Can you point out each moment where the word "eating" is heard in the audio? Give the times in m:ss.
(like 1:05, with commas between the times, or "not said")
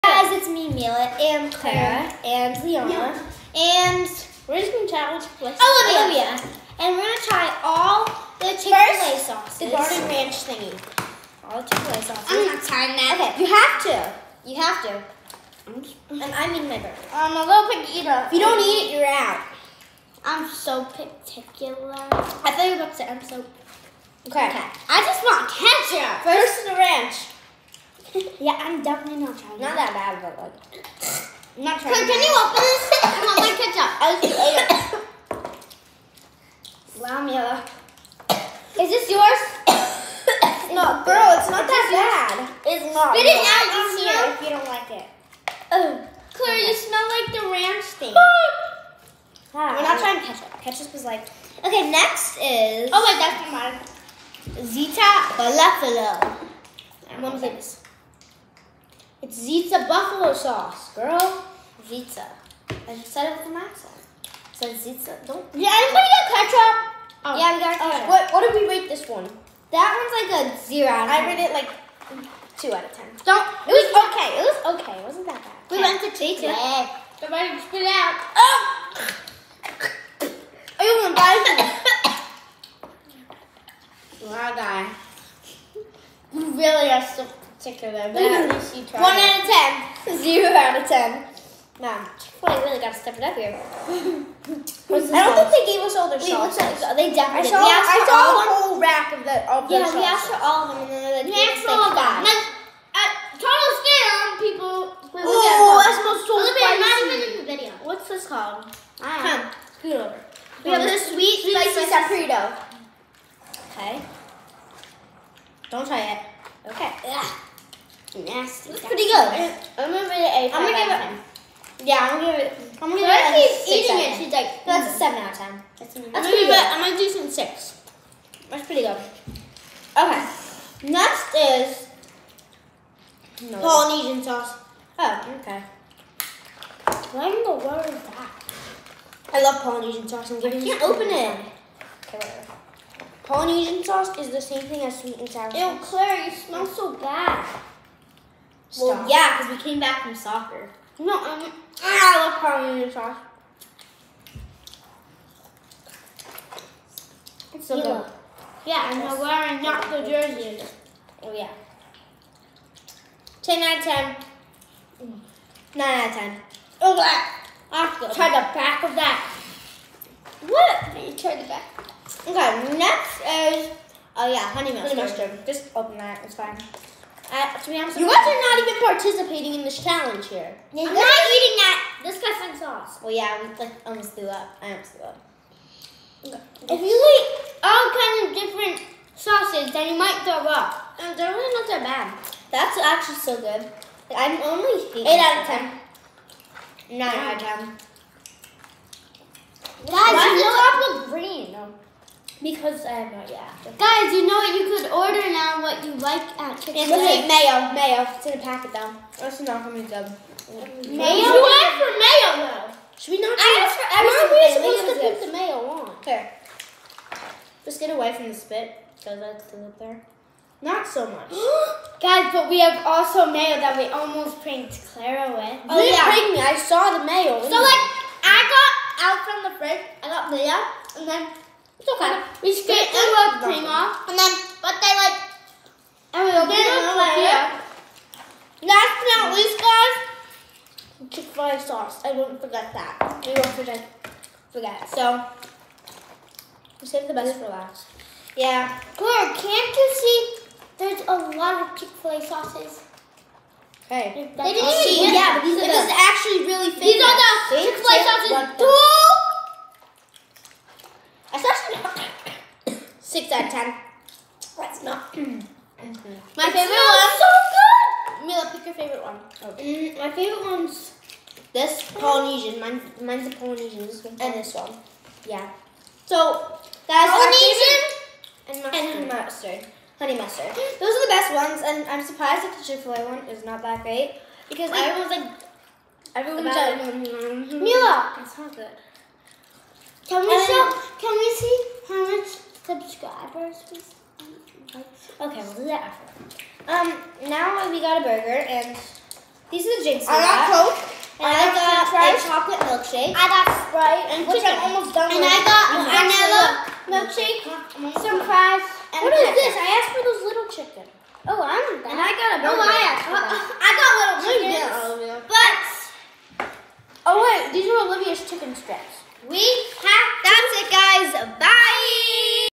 2:03, 3:01, 3:14.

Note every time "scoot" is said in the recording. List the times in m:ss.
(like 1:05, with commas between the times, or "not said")
1:49.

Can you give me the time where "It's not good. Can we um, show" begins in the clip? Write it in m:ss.
4:48.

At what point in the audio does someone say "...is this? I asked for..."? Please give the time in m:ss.
5:09.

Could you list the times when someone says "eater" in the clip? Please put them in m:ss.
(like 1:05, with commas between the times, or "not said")
0:17.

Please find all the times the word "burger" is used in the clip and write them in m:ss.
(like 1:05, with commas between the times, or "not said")
0:16, 4:58, 5:12.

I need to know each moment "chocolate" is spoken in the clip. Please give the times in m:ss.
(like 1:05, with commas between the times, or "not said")
5:02.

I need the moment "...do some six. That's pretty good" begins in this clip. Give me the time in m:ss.
2:06.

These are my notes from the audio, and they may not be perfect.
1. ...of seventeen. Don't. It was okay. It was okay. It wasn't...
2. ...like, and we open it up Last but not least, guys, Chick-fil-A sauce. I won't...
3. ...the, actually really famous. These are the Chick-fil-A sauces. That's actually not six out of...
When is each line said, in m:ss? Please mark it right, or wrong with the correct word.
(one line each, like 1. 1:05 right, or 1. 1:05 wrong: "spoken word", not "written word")
1. 1:12 wrong: "ten", not "seventeen"
2. 3:55 right
3. 4:15 right.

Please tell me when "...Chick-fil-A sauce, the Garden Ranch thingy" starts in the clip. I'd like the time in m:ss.
0:08.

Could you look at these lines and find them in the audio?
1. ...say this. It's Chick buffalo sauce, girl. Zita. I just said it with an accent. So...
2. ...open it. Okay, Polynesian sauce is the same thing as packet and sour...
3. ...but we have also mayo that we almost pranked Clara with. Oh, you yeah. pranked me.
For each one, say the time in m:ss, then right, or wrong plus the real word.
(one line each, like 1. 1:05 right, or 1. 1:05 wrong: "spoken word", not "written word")
1. 0:57 wrong: "Zita", not "Chick"
2. 2:20 wrong: "sweet", not "packet"
3. 3:42 right.